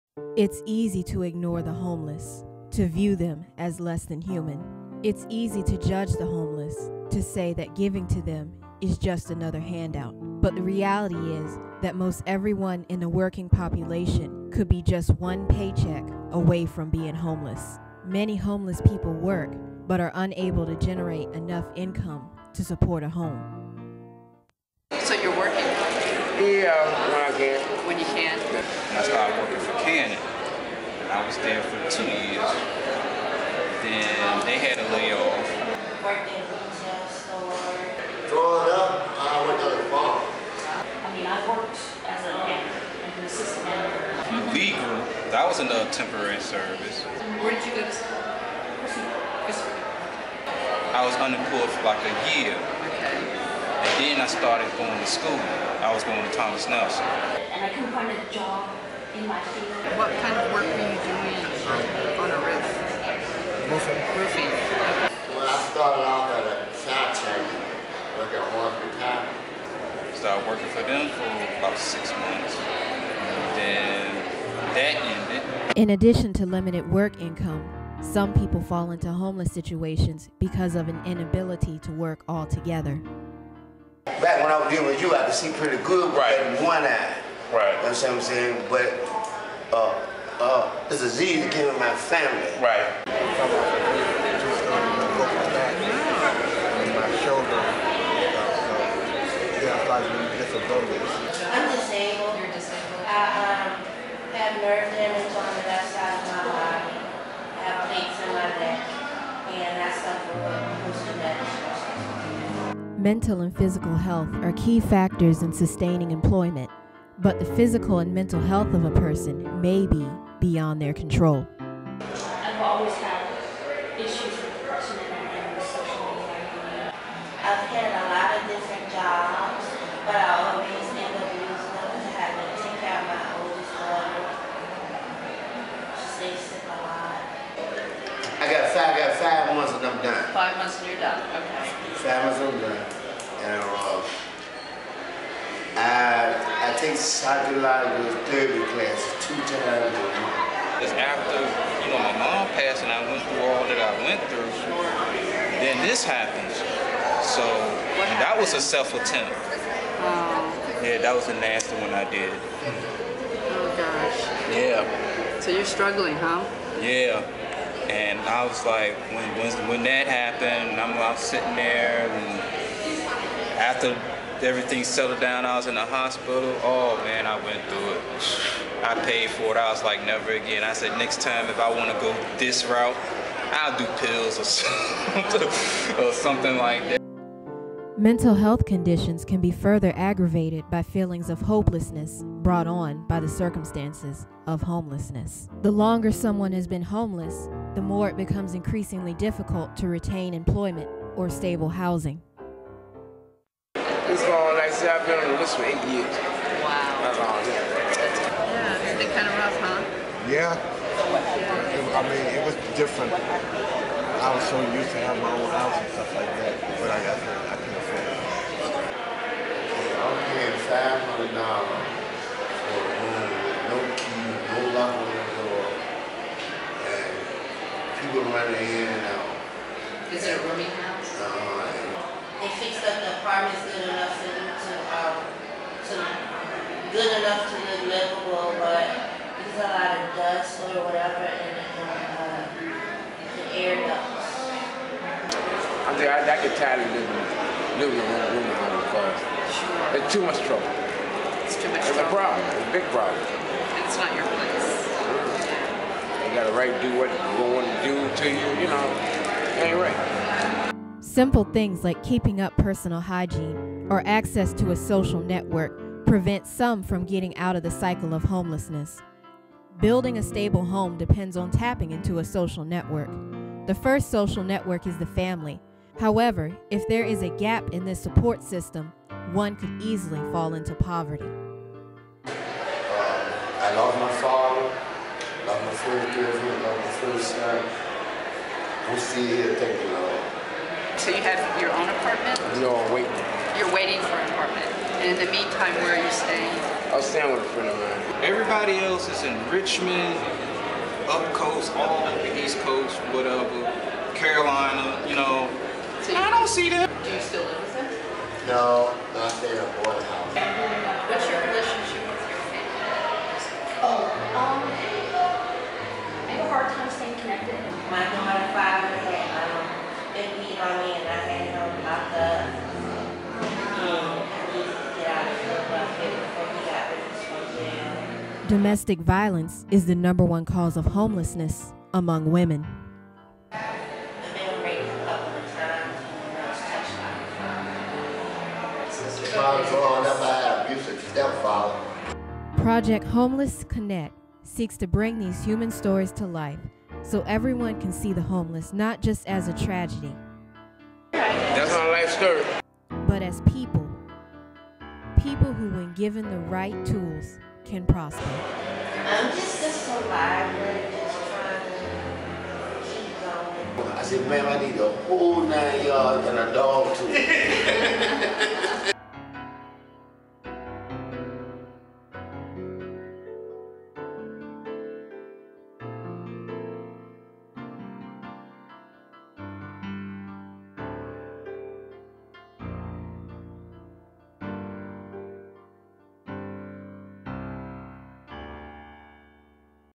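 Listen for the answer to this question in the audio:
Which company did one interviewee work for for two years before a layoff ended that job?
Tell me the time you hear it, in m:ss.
0:29.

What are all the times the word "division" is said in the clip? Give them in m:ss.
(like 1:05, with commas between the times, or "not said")
not said.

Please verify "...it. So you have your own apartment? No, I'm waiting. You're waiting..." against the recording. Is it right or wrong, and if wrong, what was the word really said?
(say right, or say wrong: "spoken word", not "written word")
right.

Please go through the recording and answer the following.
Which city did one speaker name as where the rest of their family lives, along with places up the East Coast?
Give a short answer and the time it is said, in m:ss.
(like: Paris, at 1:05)
Richmond, at 4:59.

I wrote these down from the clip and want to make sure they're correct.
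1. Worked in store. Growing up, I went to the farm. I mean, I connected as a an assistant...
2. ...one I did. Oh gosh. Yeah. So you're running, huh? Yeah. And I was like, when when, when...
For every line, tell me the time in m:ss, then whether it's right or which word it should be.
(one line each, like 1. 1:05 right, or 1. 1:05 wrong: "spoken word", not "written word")
1. 0:36 wrong: "worked", not "connected"
2. 2:41 wrong: "struggling", not "running".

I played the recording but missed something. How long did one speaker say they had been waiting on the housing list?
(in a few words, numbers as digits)
8 years.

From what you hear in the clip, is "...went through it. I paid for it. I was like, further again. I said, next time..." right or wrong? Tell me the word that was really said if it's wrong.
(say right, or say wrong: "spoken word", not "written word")
wrong: "never", not "further".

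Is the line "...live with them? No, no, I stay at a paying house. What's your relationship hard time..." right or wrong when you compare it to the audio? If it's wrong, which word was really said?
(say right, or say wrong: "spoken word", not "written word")
wrong: "boarding", not "paying".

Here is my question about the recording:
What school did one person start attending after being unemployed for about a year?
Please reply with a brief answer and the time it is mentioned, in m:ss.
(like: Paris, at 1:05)
Thomas Nelson, at 0:56.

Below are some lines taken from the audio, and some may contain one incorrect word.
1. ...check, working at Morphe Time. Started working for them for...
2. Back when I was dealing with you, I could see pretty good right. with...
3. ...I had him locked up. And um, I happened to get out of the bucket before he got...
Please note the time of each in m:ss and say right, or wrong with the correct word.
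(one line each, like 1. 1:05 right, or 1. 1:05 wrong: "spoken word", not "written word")
1. 1:07 right
2. 1:24 right
3. 5:21 wrong: "needed", not "happened".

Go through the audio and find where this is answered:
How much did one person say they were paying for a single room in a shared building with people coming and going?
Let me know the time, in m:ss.
3:41.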